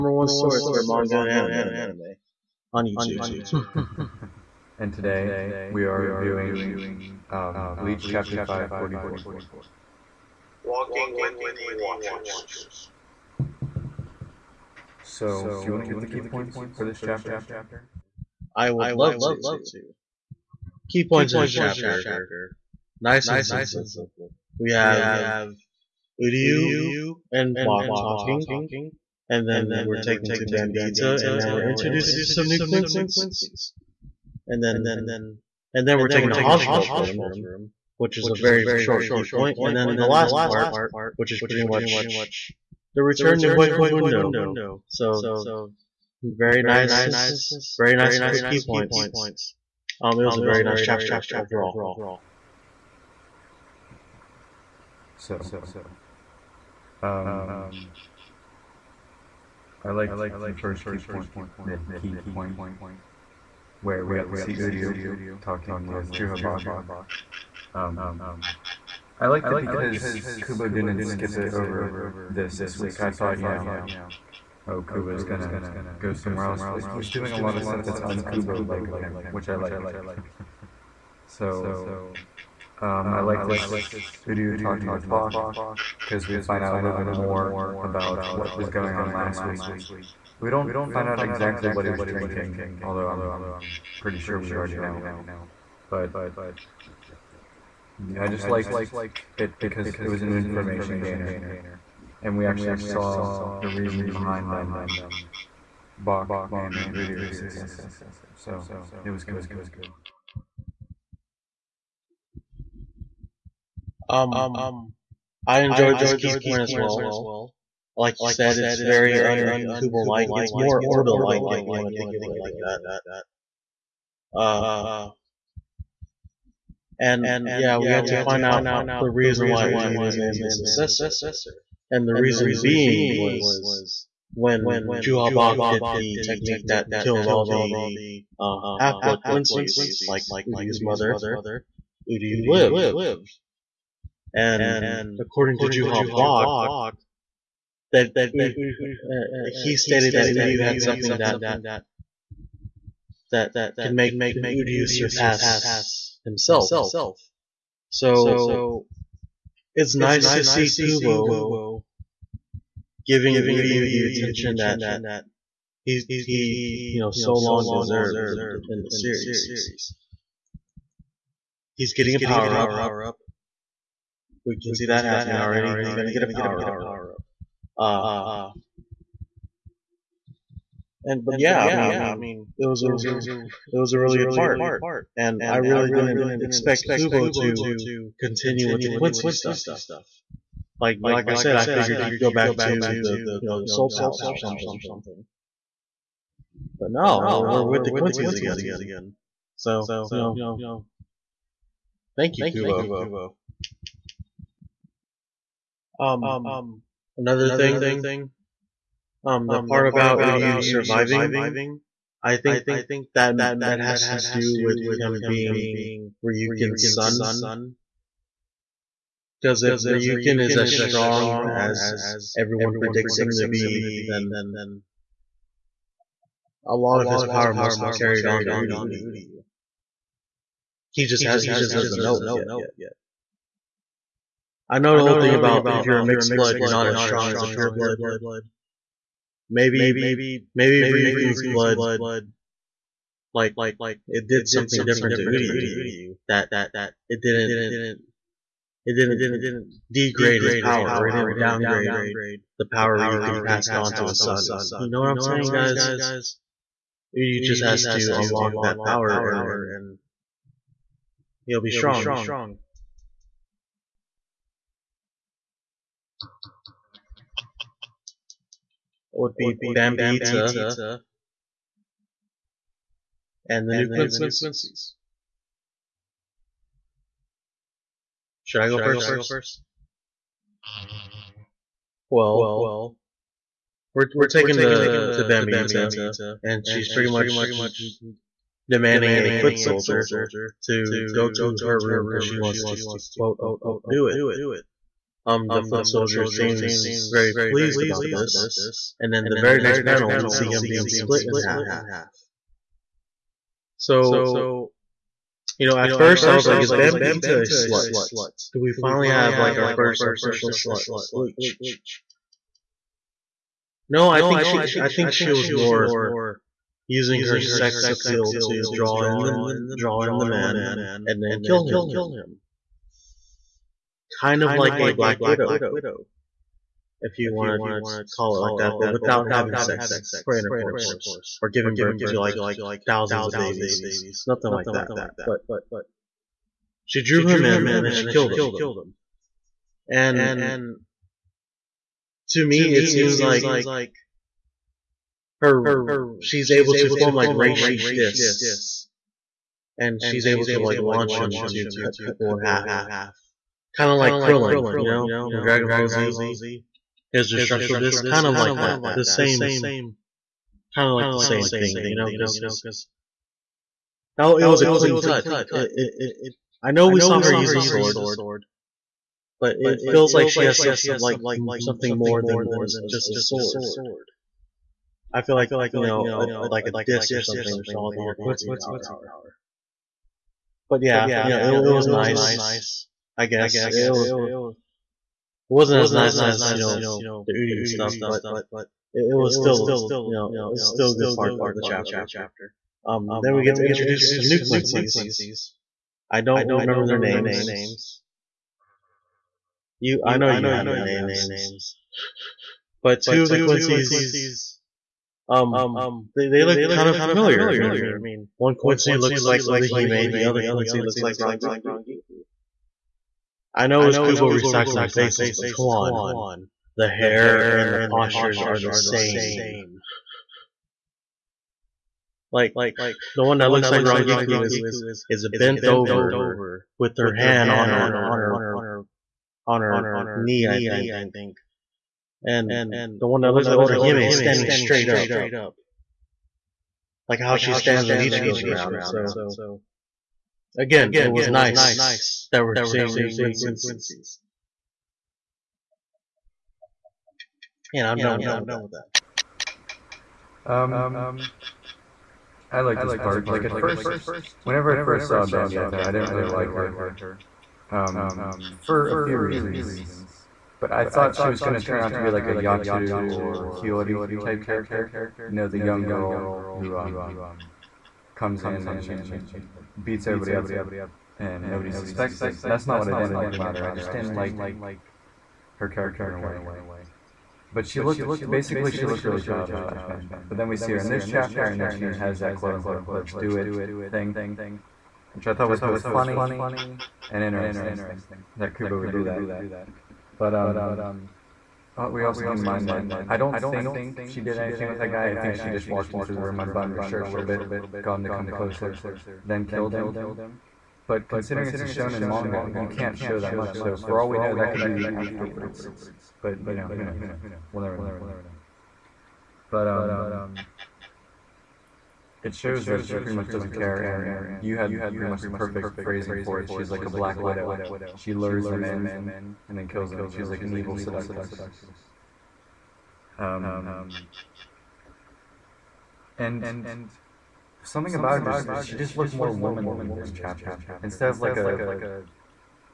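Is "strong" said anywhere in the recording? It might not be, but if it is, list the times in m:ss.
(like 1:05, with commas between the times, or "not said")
3:40, 3:56, 4:21.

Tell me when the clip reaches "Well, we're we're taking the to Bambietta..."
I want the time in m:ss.
4:42.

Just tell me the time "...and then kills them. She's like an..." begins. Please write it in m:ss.
8:39.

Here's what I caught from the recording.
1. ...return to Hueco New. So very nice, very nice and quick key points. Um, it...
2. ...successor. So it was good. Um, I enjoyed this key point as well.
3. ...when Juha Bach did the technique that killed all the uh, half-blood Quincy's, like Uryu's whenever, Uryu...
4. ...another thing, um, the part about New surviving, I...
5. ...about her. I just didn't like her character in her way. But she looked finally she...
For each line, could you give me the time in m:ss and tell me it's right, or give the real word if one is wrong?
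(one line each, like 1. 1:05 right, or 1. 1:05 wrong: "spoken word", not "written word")
1. 0:43 wrong: "Mundo", not "New"
2. 1:47 right
3. 2:14 wrong: "mother", not "whenever"
4. 3:27 wrong: "Uryu", not "New"
5. 7:53 wrong: "basically", not "finally".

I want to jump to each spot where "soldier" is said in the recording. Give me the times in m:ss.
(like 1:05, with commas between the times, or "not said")
4:49, 4:55.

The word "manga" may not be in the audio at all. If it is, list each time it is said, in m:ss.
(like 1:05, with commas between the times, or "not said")
0:00, 8:22.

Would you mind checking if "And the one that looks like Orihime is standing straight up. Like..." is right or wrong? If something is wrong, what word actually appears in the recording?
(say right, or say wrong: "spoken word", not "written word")
right.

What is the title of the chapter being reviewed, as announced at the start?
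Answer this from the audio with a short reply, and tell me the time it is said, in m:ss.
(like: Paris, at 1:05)
Walking with the Watchers, at 0:10.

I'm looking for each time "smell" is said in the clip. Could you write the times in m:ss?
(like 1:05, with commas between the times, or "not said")
not said.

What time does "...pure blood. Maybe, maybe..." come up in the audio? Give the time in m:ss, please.
3:57.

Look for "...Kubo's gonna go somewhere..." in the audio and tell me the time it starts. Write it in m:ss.
1:14.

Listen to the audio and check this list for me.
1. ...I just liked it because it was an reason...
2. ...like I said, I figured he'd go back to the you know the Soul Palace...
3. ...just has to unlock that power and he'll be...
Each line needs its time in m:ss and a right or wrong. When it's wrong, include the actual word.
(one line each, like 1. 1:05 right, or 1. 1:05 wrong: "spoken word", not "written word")
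1. 1:38 wrong: "information", not "reason"
2. 3:11 right
3. 4:17 right.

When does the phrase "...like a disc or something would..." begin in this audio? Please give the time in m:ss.
6:16.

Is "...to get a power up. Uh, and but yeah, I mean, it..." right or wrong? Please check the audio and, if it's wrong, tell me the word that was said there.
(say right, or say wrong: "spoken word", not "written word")
right.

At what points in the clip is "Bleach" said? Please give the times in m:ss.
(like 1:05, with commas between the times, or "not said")
0:07, 5:11.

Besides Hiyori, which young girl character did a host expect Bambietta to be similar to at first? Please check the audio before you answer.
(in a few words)
Yachiru.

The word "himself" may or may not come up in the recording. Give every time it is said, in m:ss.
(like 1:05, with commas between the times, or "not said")
2:36.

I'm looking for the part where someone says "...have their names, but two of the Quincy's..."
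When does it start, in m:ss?
6:40.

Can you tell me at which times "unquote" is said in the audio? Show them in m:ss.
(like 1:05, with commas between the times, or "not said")
4:53, 8:02.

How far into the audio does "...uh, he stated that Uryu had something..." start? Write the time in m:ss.
2:28.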